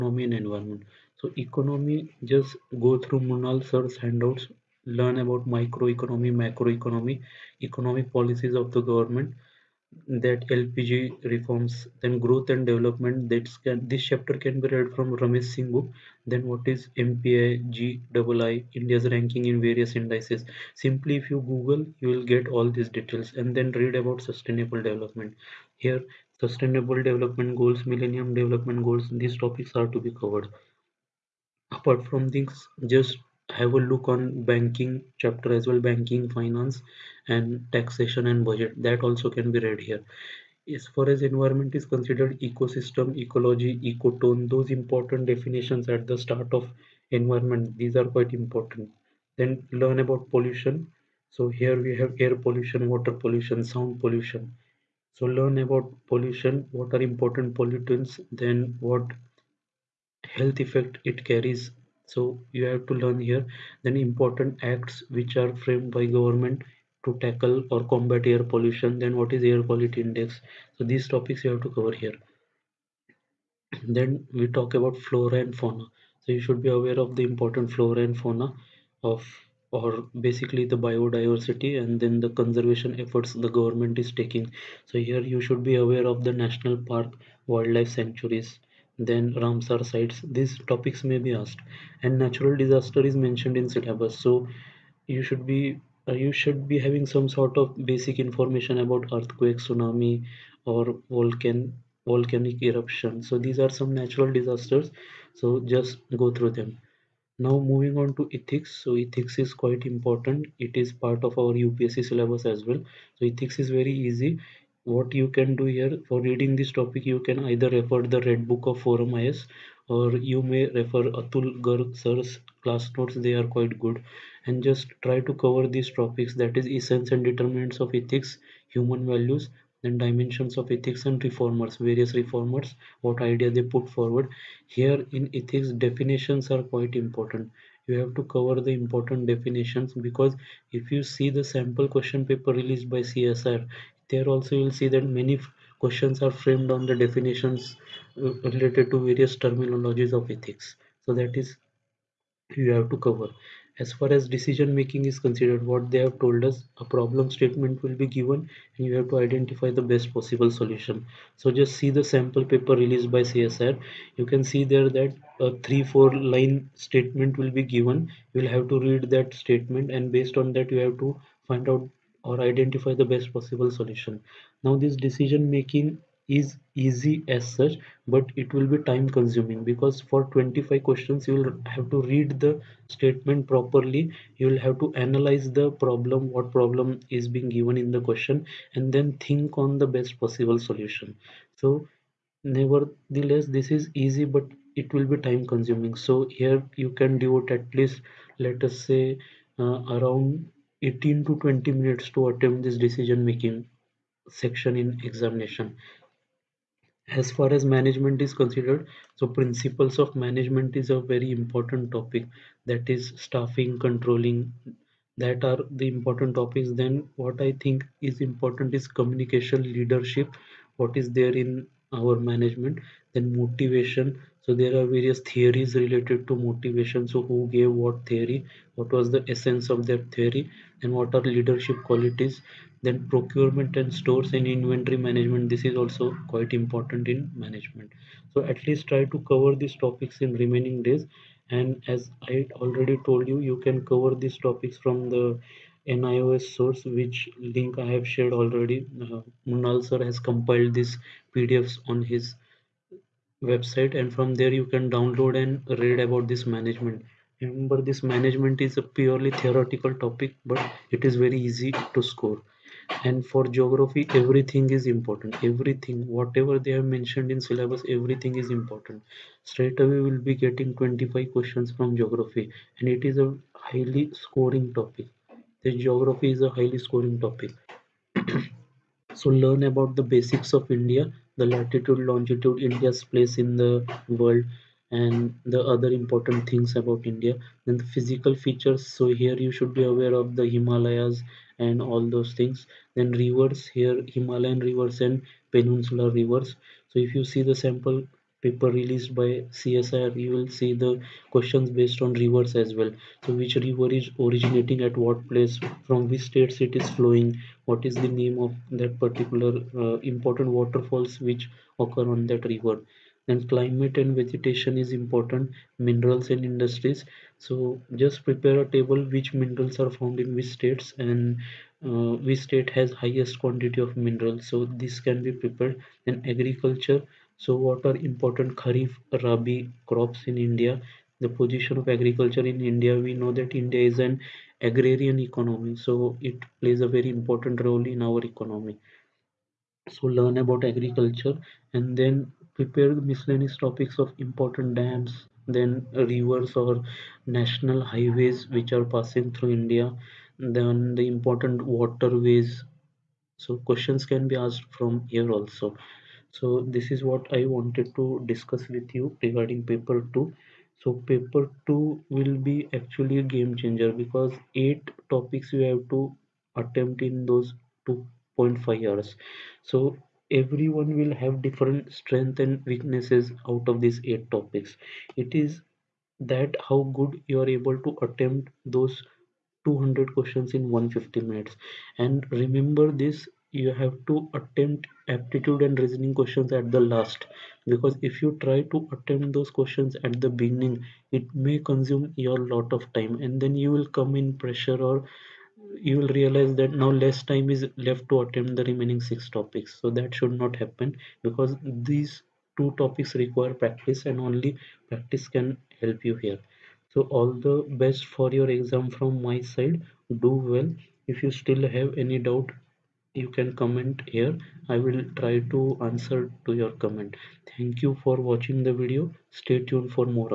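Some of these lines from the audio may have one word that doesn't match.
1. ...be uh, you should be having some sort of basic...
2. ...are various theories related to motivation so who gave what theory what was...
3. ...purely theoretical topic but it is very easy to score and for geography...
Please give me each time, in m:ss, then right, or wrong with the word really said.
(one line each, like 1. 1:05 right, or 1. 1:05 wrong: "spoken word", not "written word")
1. 1:35 right
2. 3:44 right
3. 4:18 right.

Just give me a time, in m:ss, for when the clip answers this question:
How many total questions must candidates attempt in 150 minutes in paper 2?
6:19.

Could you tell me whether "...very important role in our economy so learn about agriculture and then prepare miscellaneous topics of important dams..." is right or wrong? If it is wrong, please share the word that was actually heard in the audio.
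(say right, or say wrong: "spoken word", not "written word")
right.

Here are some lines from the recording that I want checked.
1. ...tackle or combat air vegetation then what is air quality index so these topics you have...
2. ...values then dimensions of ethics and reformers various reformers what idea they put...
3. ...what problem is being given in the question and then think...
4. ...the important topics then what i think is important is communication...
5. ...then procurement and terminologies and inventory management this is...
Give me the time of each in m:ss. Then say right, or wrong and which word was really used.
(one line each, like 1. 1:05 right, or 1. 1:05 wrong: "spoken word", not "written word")
1. 1:07 wrong: "pollution", not "vegetation"
2. 2:09 right
3. 3:06 right
4. 3:35 right
5. 3:52 wrong: "stores", not "terminologies".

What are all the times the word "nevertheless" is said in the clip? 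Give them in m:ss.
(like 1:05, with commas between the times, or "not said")
3:12.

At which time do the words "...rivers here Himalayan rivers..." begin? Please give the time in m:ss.
4:53.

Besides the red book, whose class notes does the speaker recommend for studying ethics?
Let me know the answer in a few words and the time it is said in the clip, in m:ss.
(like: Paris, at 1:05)
Atul Garg, at 2:01.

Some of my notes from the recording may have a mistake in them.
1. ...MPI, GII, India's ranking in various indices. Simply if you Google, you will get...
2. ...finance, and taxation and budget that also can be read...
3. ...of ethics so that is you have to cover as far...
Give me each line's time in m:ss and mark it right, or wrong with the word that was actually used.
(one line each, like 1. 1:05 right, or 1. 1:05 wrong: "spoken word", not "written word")
1. 0:16 right
2. 0:36 right
3. 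2:30 right.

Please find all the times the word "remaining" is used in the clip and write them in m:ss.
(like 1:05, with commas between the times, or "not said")
4:00, 6:38.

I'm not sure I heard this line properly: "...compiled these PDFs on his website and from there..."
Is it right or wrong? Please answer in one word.
right.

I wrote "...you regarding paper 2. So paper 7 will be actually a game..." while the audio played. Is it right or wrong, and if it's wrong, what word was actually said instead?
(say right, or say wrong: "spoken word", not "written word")
wrong: "2", not "7".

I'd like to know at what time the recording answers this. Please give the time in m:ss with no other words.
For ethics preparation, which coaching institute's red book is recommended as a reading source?
1:58.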